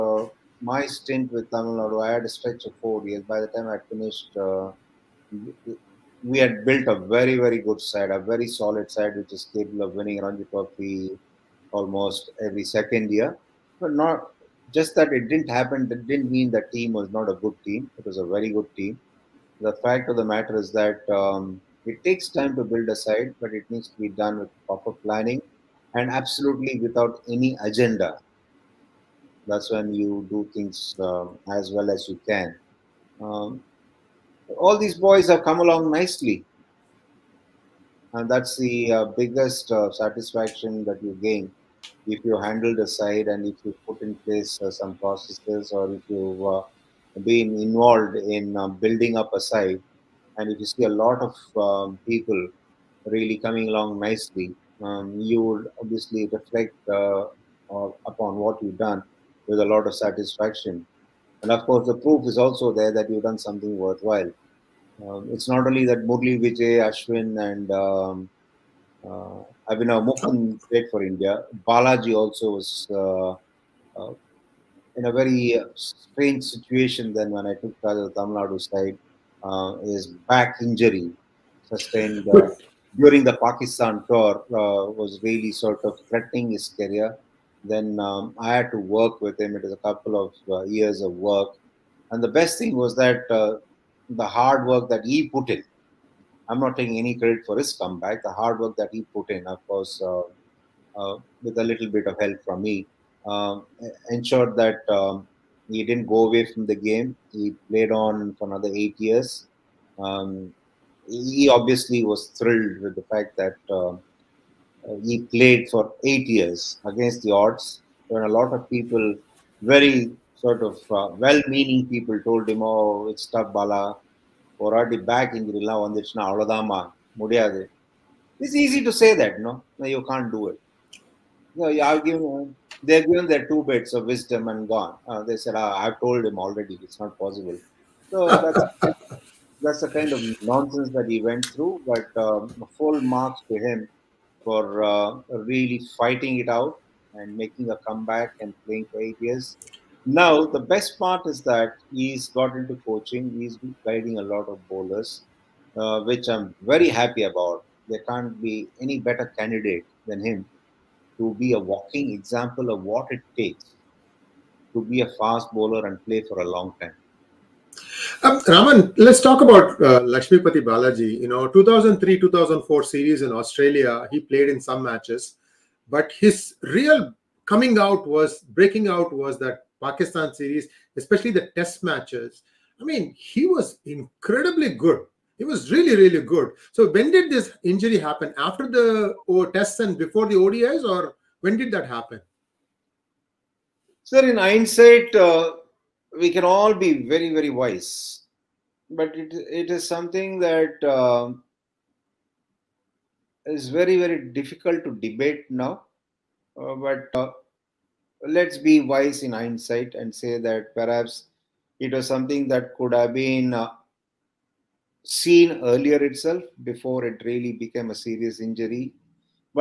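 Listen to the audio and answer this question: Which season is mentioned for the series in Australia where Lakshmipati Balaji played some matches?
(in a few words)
2003-2004.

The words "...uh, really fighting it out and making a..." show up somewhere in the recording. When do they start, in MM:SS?
02:24.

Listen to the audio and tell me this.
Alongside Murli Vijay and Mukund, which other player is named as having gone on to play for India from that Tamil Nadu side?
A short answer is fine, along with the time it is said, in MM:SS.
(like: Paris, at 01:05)
Ashwin, at 01:06.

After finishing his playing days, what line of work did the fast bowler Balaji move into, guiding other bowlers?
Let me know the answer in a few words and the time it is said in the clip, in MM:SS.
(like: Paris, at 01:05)
Coaching, at 02:32.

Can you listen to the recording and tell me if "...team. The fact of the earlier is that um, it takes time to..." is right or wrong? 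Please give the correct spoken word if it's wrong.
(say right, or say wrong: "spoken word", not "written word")
wrong: "matter", not "earlier".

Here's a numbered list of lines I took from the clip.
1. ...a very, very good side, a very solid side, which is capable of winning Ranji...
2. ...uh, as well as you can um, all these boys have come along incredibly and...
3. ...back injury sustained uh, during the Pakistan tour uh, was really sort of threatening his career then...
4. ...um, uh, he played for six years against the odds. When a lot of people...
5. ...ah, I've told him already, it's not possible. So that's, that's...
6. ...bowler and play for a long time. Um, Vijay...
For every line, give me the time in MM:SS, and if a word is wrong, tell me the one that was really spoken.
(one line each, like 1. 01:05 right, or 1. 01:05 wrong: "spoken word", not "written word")
1. 00:06 right
2. 00:30 wrong: "nicely", not "incredibly"
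3. 01:20 right
4. 01:53 wrong: "eight", not "six"
5. 02:15 right
6. 02:45 wrong: "Raman", not "Vijay".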